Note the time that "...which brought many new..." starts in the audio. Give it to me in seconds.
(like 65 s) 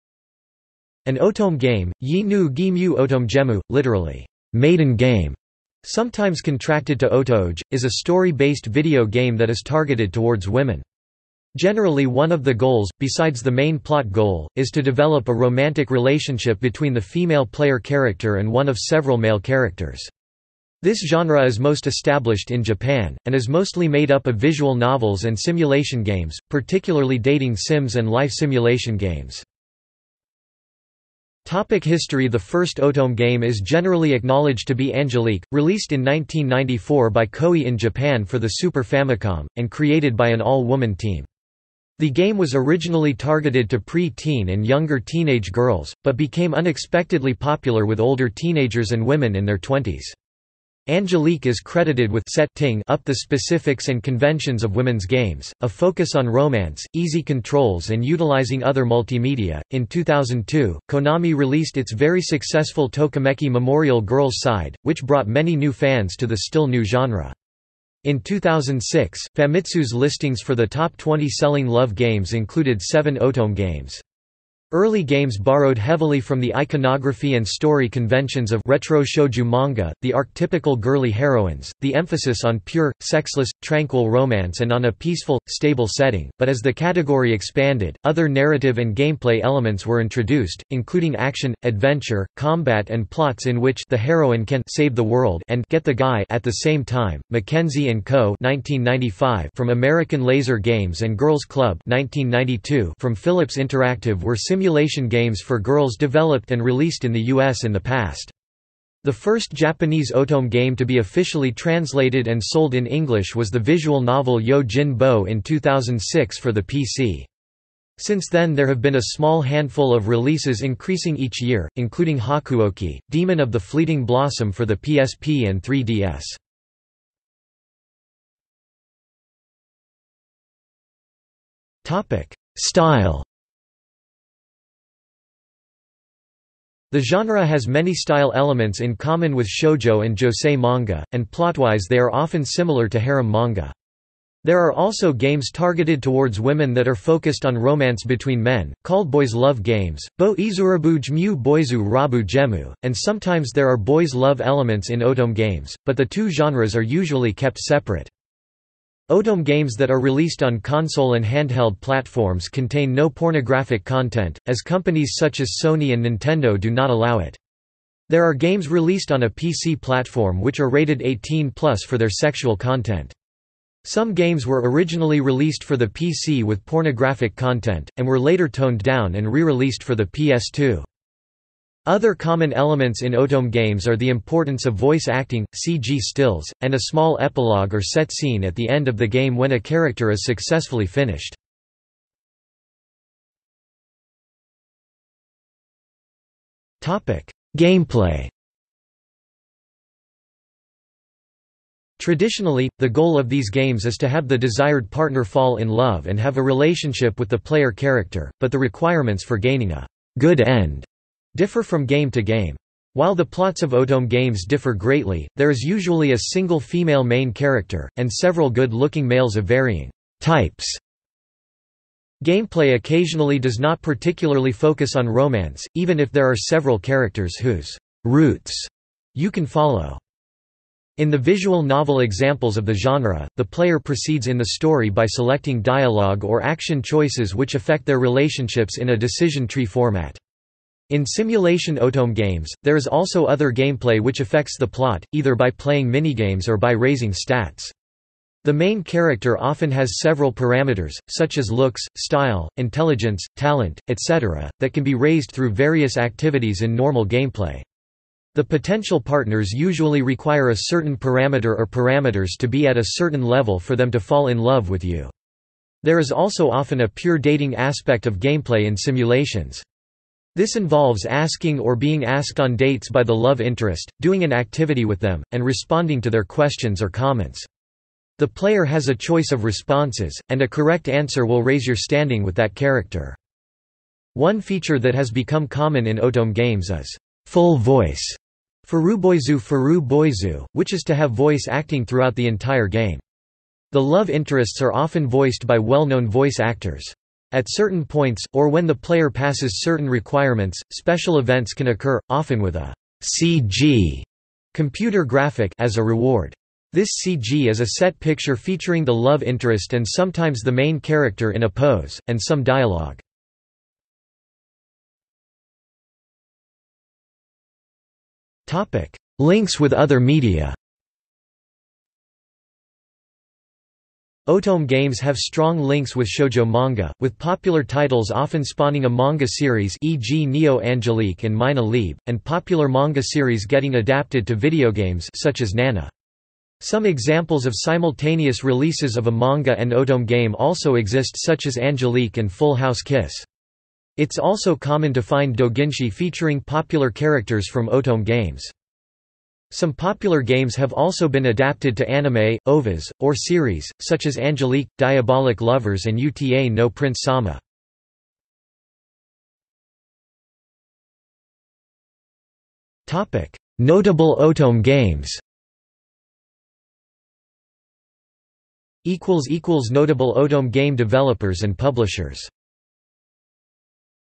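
64 s.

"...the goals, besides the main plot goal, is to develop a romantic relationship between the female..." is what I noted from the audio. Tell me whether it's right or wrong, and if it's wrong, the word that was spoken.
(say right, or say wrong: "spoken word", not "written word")
right.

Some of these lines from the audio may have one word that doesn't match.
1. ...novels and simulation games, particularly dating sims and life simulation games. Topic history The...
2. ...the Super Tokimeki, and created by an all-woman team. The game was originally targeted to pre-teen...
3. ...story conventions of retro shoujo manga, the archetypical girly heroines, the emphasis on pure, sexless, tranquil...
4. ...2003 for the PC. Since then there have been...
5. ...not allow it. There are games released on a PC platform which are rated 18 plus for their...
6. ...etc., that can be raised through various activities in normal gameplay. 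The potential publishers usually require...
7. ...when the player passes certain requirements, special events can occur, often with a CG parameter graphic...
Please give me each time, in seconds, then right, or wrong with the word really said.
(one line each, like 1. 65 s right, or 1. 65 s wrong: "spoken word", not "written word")
1. 24 s right
2. 38 s wrong: "Famicom", not "Tokimeki"
3. 77 s right
4. 115 s wrong: "2006", not "2003"
5. 166 s right
6. 253 s wrong: "partners", not "publishers"
7. 298 s wrong: "computer", not "parameter".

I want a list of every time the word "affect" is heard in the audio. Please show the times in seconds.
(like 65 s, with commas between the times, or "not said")
237 s, 244 s.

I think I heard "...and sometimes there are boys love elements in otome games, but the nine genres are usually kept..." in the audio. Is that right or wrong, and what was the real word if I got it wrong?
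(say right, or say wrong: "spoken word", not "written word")
wrong: "two", not "nine".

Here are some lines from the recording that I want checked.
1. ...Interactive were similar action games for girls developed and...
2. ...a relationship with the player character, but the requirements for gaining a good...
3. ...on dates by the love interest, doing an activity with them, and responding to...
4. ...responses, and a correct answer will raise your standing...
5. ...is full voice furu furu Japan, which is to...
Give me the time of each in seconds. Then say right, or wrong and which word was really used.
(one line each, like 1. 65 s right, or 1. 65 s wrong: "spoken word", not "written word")
1. 103 s wrong: "simulation", not "action"
2. 206 s right
3. 272 s right
4. 279 s right
5. 286 s wrong: "Furuboizu", not "Japan".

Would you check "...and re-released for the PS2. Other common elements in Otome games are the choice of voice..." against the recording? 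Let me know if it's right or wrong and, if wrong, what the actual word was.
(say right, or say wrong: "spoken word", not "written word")
wrong: "importance", not "choice".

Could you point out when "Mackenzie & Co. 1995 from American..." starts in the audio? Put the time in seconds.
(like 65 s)
97 s.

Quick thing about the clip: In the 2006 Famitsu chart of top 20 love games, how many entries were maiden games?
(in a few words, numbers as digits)
7.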